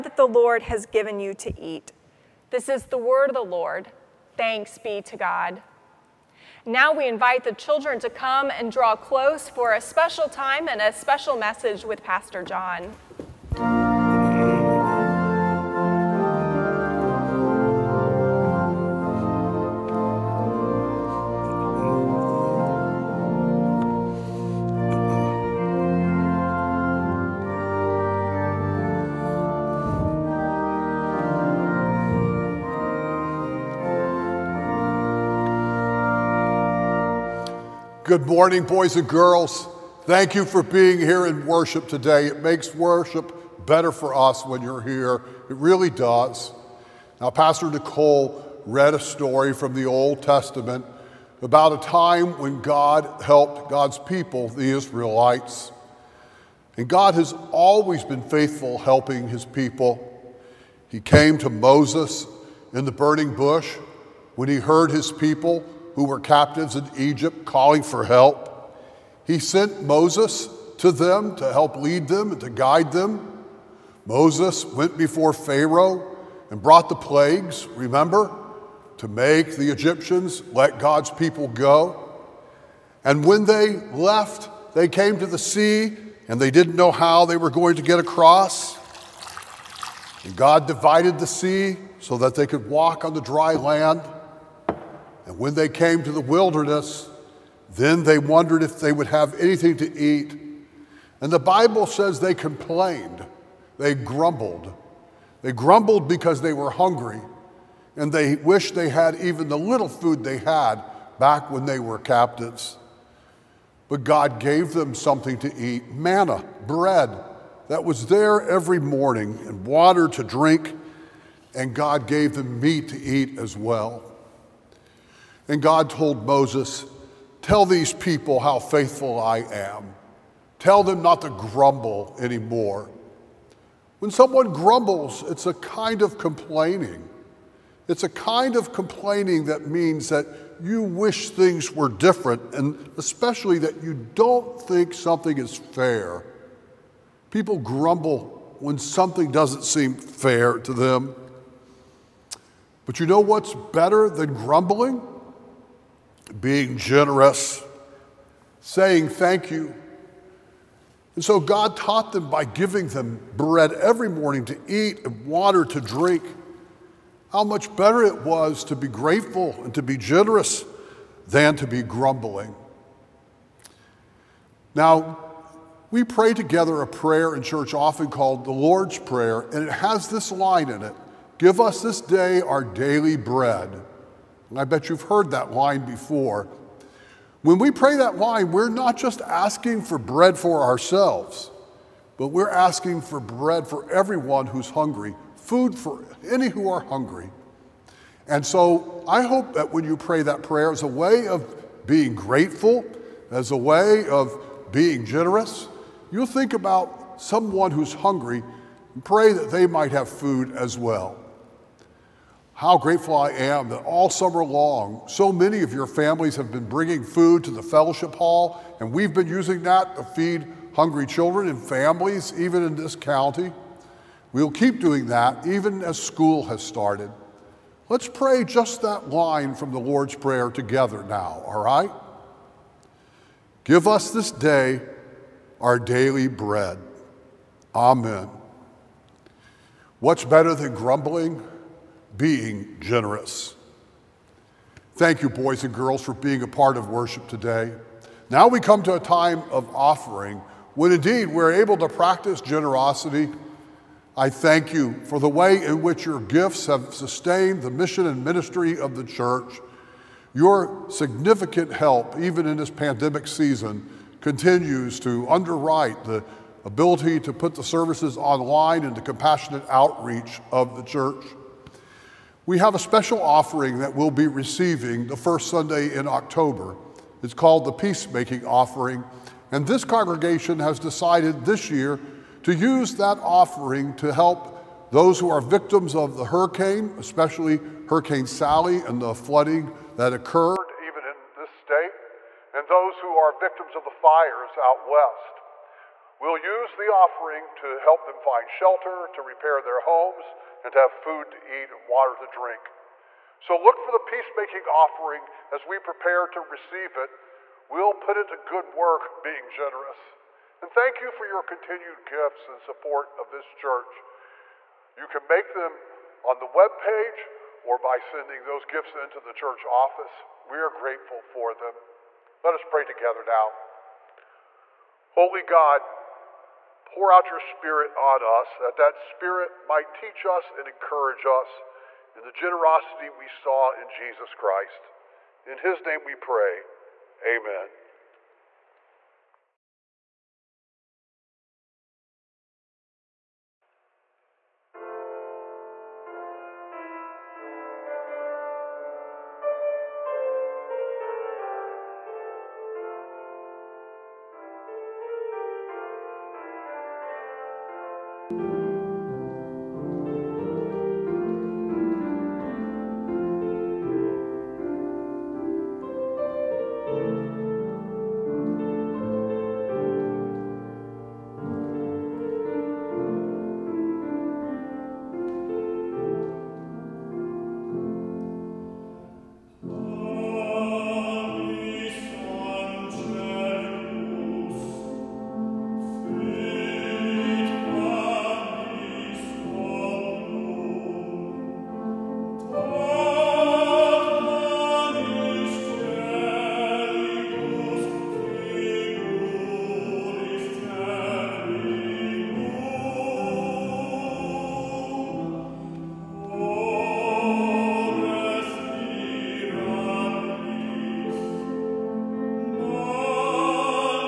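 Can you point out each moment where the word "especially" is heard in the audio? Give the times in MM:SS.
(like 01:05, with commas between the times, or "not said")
02:22, 04:46.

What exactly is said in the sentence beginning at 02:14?
When someone grumbles, it's a kind of complaining.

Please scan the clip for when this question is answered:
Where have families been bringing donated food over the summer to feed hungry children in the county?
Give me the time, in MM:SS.
03:37.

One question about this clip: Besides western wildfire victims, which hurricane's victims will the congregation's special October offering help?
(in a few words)
Hurricane Sally.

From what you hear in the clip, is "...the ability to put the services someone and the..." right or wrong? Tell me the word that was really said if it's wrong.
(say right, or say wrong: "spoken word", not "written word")
wrong: "online", not "someone".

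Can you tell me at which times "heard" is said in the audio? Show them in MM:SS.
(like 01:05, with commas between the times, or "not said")
01:04, 03:05.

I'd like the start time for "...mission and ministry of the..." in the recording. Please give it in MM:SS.
04:17.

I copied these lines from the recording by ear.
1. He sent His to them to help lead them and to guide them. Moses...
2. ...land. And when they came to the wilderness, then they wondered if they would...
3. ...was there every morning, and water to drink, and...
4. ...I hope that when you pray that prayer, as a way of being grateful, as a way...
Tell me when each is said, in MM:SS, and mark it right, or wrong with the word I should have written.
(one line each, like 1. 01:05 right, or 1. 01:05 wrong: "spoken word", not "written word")
1. 01:09 wrong: "Moses", not "His"
2. 01:33 right
3. 01:57 right
4. 03:19 right.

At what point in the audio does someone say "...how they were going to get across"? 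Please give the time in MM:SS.
01:26.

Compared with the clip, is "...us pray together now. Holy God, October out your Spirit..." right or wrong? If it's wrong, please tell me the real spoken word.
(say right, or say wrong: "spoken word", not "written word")
wrong: "Pour", not "October".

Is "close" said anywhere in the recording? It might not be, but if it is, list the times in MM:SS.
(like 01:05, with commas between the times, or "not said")
00:08.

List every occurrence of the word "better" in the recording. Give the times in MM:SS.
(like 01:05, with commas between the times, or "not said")
00:43, 02:33, 02:47, 04:00.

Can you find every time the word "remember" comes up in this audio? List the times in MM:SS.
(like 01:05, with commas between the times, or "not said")
01:17.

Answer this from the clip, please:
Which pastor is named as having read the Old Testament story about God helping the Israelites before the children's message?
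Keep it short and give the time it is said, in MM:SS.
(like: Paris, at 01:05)
Pastor Nicole, at 00:47.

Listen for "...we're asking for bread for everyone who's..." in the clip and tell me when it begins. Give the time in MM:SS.
03:12.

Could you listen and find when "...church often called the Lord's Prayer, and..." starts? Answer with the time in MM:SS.
02:57.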